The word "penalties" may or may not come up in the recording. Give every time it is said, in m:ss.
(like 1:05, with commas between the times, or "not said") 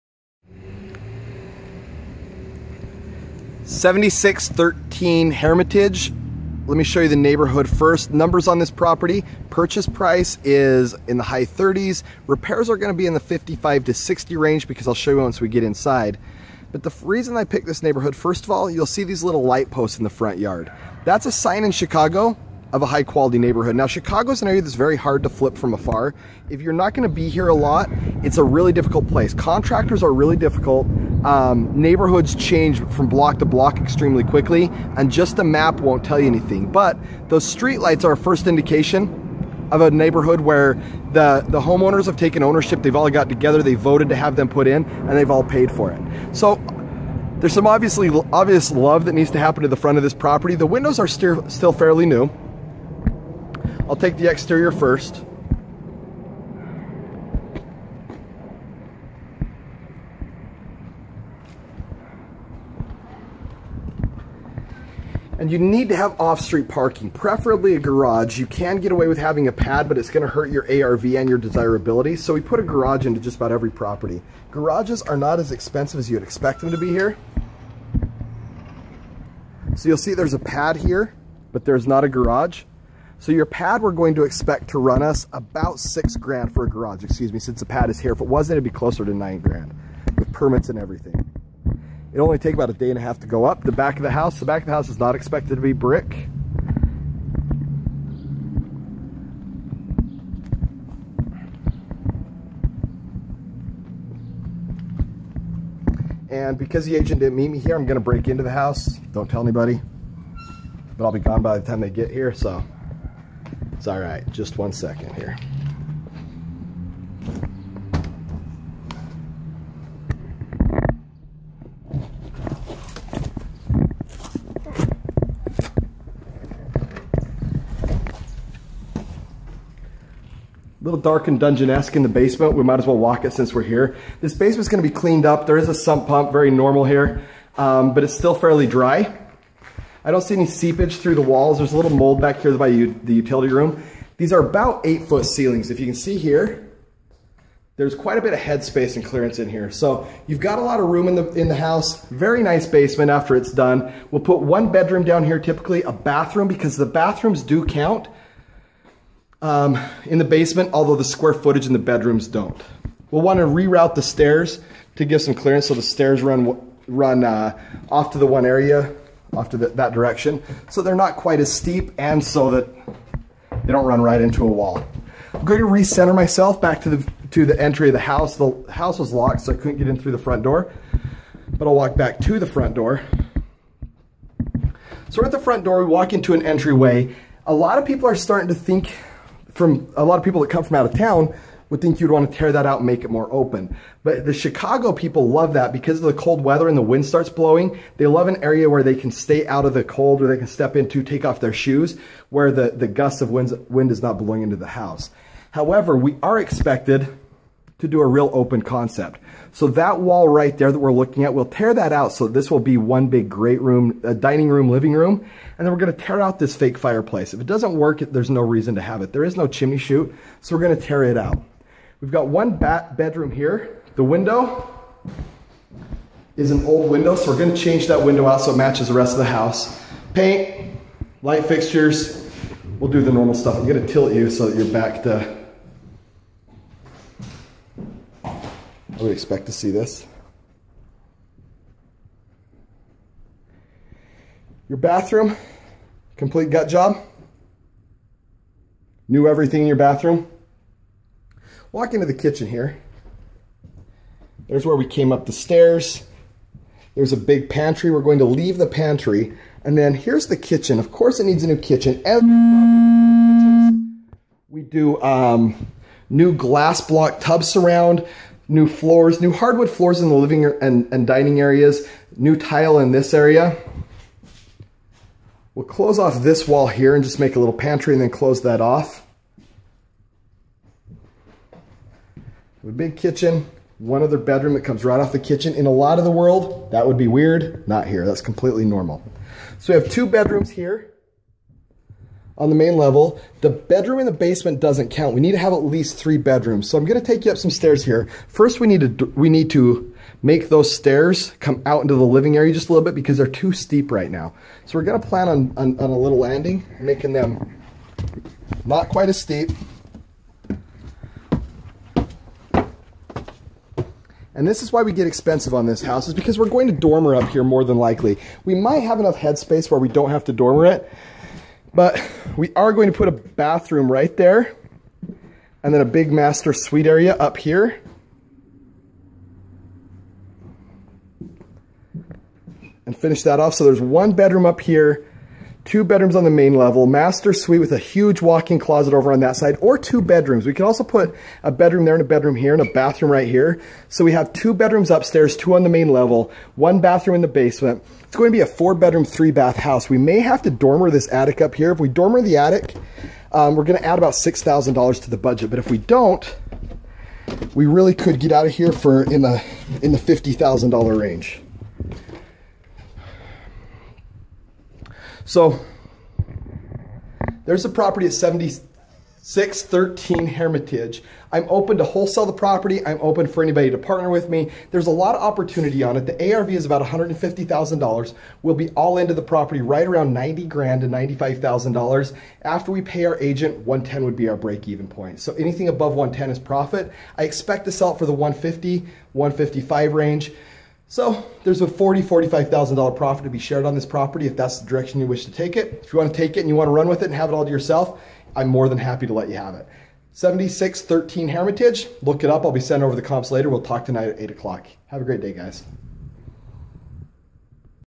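not said.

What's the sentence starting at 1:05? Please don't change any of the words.
And you need to have off-street parking, preferably a garage.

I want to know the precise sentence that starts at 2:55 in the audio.
I'm going to recenter myself back to the, to the entry of the house.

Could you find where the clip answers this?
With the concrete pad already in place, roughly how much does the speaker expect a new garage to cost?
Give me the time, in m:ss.
1:25.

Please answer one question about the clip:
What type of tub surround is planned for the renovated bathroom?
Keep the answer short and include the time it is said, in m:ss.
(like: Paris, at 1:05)
glass block, at 4:26.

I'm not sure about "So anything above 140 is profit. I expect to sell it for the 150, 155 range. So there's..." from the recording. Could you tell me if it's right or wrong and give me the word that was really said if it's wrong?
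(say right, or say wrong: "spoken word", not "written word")
wrong: "110", not "140".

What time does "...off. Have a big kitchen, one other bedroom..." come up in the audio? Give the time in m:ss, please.
4:38.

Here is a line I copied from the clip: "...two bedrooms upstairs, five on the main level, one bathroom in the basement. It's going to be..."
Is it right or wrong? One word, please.
wrong.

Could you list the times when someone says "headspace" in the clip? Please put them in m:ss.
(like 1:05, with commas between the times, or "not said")
2:28, 5:19.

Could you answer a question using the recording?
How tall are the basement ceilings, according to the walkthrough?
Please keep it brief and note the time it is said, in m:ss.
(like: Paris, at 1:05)
8 feet, at 2:24.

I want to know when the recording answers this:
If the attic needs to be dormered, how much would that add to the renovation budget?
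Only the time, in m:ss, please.
5:54.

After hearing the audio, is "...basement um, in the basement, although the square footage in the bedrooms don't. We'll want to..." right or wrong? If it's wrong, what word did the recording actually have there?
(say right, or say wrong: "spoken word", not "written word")
wrong: "count", not "basement".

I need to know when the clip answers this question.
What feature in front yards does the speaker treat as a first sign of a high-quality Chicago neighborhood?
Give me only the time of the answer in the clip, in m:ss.
0:19.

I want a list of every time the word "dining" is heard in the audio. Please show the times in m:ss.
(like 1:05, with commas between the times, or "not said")
3:34, 4:31.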